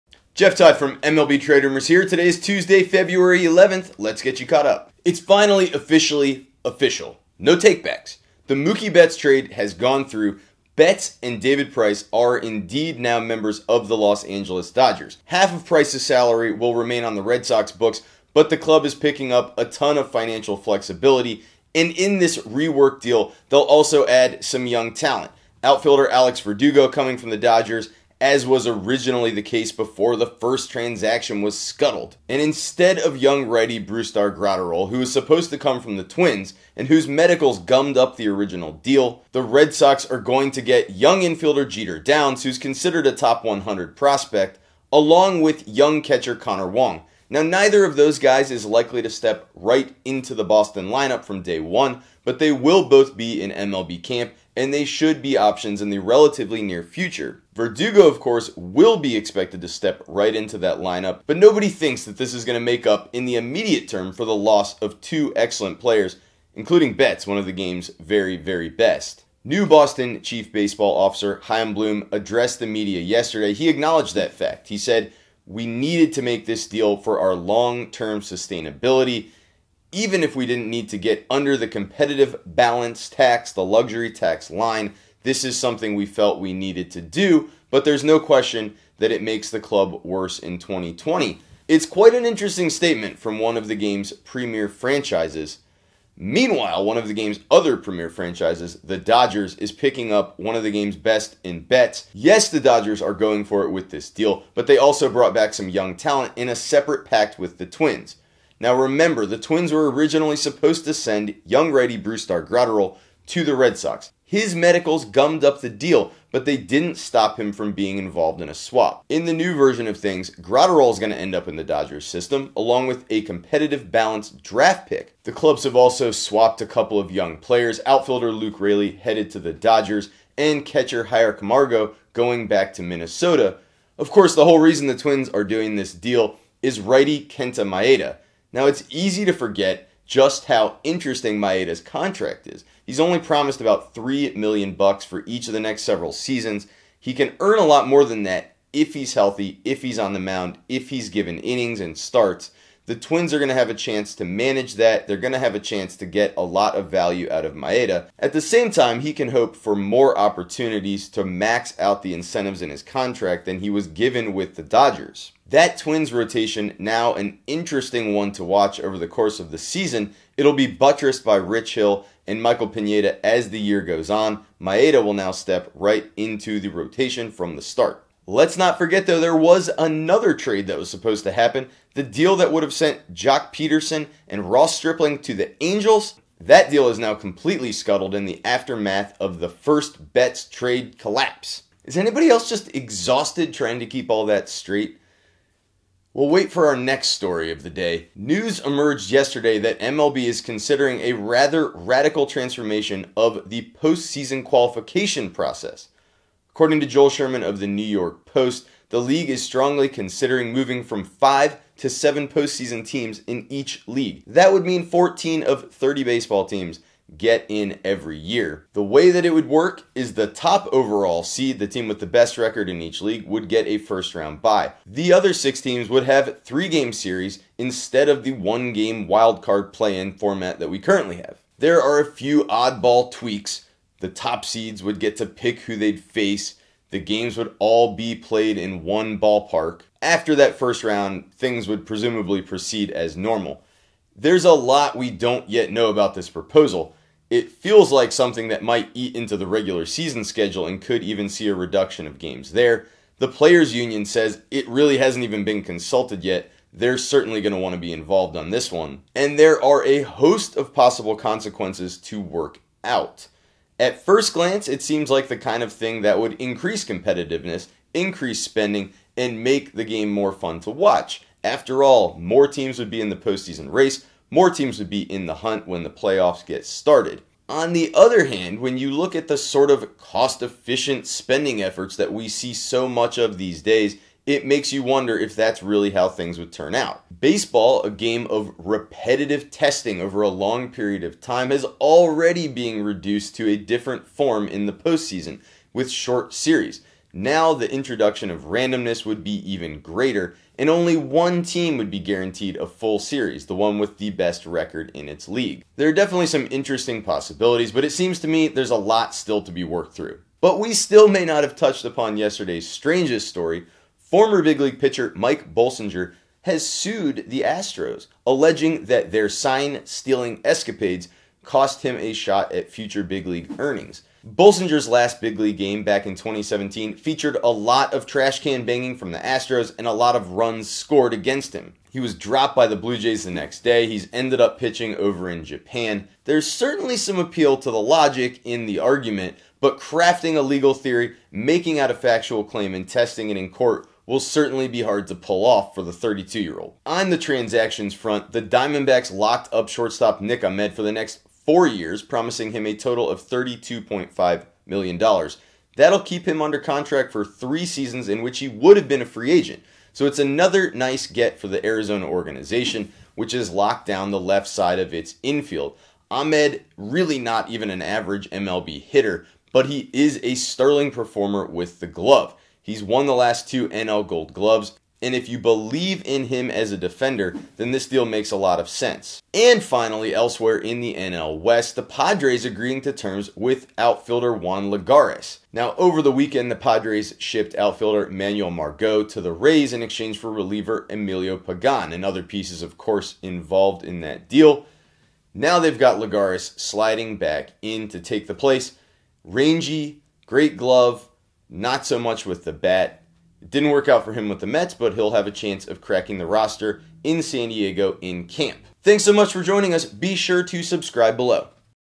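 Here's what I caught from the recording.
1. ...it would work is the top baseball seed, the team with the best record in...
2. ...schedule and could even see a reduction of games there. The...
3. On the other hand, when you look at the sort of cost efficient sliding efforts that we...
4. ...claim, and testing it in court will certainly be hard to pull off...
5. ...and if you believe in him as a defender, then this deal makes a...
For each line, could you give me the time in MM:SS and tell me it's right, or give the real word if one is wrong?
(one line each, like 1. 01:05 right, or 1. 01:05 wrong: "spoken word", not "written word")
1. 03:39 wrong: "overall", not "baseball"
2. 04:10 right
3. 04:37 wrong: "spending", not "sliding"
4. 05:42 right
5. 06:15 right.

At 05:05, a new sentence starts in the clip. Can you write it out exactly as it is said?
There are definitely some interesting possibilities, but it seems to me there's a lot still to be worked through.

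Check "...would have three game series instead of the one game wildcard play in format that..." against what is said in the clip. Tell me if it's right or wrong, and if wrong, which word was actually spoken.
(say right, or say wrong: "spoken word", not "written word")
right.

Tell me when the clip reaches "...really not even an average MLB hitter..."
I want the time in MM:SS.
06:06.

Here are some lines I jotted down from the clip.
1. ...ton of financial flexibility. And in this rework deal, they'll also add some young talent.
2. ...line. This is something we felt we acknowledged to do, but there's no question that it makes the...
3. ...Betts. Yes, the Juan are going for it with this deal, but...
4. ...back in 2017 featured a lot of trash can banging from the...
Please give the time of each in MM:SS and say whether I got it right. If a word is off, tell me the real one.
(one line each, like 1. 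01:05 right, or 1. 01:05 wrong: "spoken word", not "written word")
1. 00:19 right
2. 01:24 wrong: "needed", not "acknowledged"
3. 01:41 wrong: "Dodgers", not "Juan"
4. 05:25 right.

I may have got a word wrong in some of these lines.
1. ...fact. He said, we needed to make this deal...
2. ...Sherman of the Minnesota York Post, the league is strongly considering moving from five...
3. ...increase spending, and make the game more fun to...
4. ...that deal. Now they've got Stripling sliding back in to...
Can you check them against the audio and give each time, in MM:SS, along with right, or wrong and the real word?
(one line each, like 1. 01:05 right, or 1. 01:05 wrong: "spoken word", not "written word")
1. 01:14 right
2. 03:27 wrong: "New", not "Minnesota"
3. 04:27 right
4. 06:34 wrong: "Lagares", not "Stripling".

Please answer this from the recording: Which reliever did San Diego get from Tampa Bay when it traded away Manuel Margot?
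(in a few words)
Emilio Pagan.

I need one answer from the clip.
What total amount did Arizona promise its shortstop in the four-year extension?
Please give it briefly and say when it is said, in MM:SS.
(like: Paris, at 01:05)
$32.5 million, at 05:53.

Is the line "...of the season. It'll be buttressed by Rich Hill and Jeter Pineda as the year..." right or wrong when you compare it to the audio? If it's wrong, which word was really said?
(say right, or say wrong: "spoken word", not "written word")
wrong: "Michael", not "Jeter".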